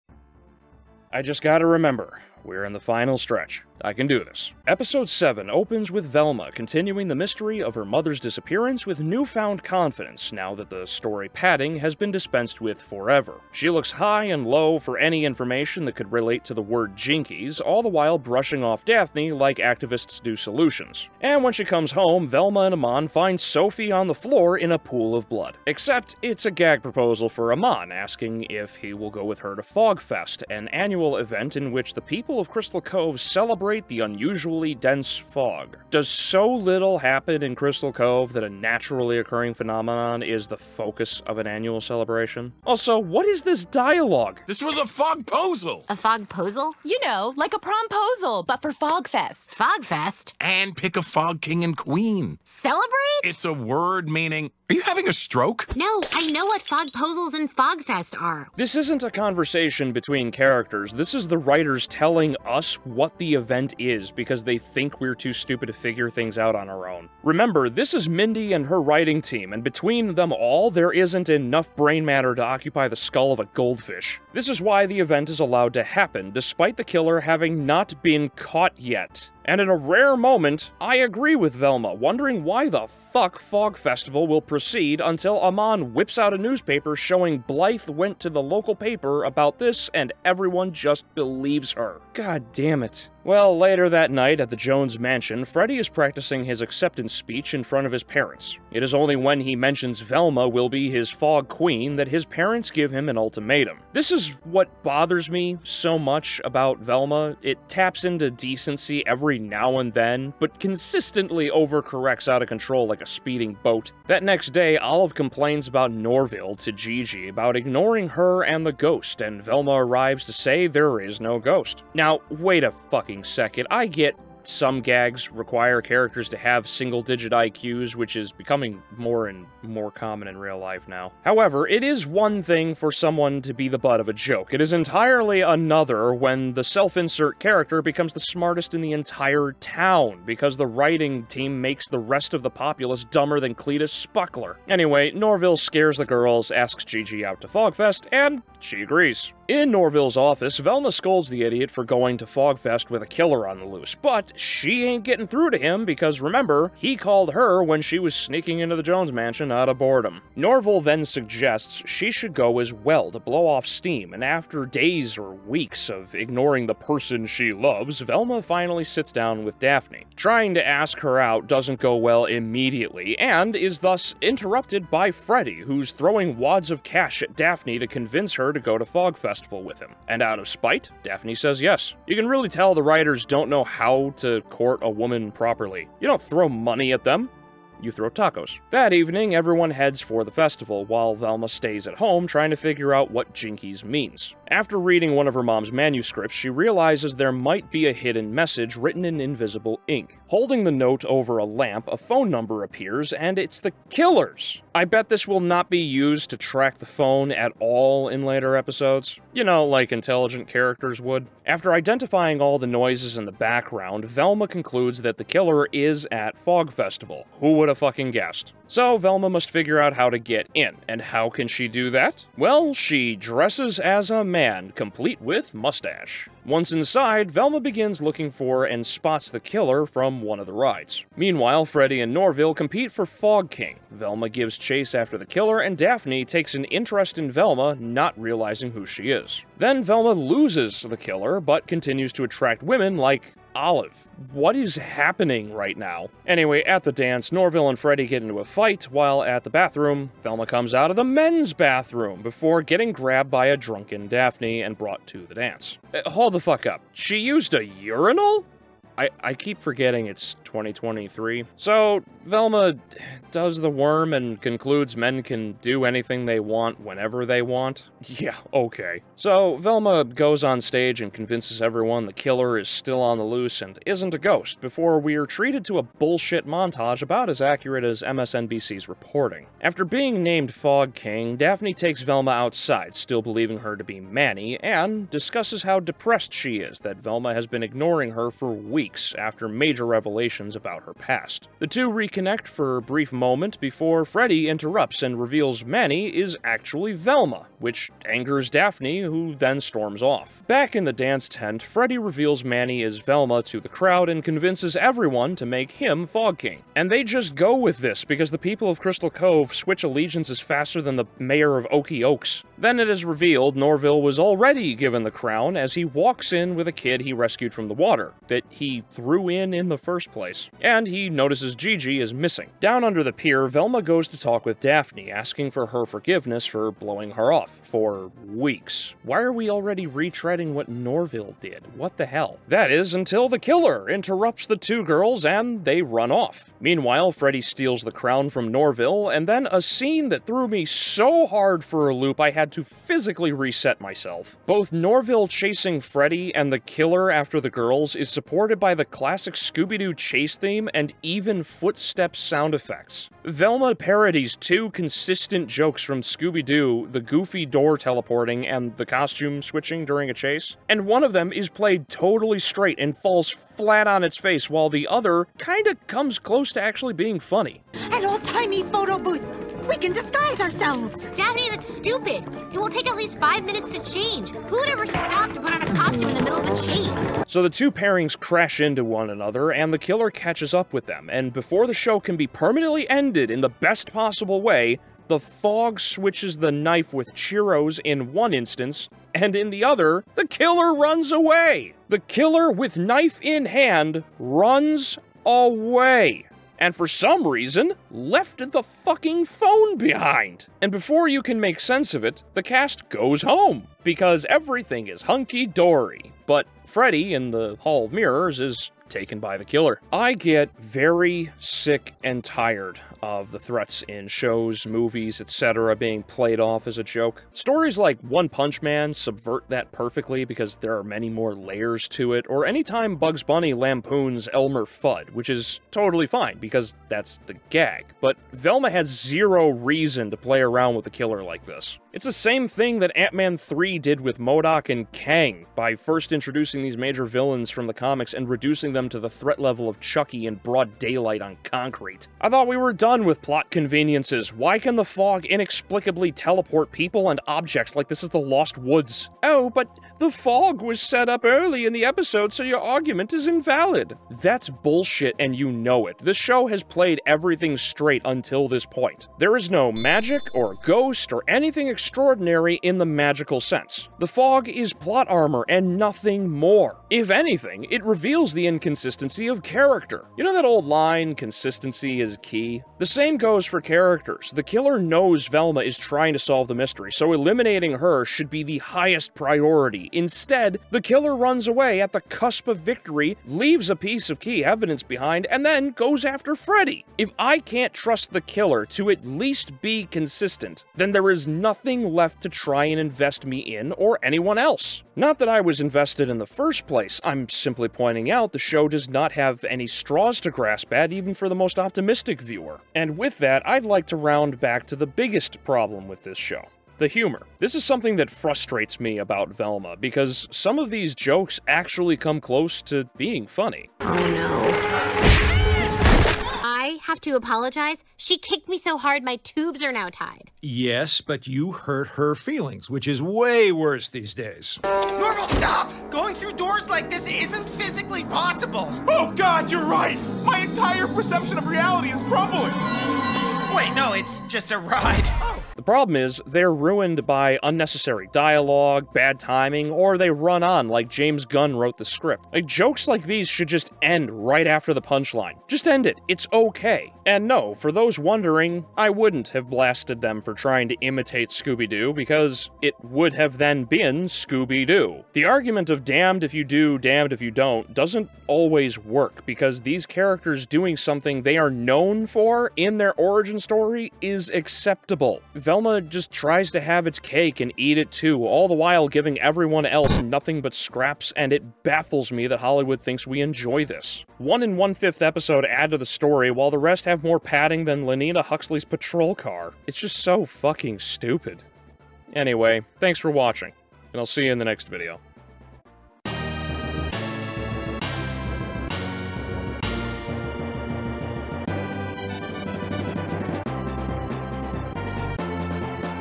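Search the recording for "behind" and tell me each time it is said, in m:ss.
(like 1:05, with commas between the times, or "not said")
6:39, 8:04.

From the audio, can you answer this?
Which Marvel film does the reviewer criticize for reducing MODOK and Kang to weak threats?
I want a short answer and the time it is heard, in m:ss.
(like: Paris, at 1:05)
Ant-Man 3, at 7:12.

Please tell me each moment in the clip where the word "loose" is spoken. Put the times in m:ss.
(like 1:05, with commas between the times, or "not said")
2:33, 4:33.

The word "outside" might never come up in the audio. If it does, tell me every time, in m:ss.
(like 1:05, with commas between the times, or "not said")
4:42.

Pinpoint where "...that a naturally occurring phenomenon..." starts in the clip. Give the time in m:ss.
0:38.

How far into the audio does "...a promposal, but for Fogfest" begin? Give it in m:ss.
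0:47.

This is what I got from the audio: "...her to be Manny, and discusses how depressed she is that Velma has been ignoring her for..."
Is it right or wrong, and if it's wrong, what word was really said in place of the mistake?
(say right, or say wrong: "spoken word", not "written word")
right.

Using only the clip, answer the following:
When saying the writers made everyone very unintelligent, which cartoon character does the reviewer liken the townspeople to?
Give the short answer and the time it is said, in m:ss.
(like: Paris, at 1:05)
Cletus Spuckler, at 2:23.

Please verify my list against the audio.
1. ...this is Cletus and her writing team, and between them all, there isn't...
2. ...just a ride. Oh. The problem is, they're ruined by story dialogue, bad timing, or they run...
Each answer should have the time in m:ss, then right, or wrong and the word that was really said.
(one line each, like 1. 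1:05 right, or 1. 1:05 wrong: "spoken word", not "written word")
1. 1:07 wrong: "Mindy", not "Cletus"
2. 8:54 wrong: "unnecessary", not "story".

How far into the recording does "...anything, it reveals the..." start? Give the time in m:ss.
7:47.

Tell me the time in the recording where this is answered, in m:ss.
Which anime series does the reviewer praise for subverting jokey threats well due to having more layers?
6:58.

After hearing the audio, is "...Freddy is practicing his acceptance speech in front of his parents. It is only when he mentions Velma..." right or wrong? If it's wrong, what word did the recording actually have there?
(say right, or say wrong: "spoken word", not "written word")
right.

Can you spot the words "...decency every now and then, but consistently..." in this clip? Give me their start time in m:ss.
1:48.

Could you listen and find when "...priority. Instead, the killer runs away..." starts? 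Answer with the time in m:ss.
7:59.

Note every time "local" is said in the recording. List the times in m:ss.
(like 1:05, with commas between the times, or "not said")
1:28.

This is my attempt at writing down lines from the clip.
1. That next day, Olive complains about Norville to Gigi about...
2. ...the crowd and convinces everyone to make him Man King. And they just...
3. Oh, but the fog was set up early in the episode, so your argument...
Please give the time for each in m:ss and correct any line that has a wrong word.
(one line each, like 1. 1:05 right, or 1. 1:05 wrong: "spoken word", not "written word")
1. 1:54 right
2. 5:03 wrong: "Fog", not "Man"
3. 7:29 right.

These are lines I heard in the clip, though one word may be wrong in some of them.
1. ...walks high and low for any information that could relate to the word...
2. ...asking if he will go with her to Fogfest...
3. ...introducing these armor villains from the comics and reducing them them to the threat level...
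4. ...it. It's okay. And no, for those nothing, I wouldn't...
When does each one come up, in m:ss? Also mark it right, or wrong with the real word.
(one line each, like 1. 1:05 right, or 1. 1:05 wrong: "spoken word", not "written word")
1. 0:13 wrong: "looks", not "walks"
2. 0:27 right
3. 7:16 wrong: "major", not "armor"
4. 9:05 wrong: "wondering", not "nothing".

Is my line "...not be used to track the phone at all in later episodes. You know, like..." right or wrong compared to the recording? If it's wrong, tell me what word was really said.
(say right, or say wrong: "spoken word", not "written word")
right.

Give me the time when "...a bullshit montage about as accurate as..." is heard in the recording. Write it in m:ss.
4:35.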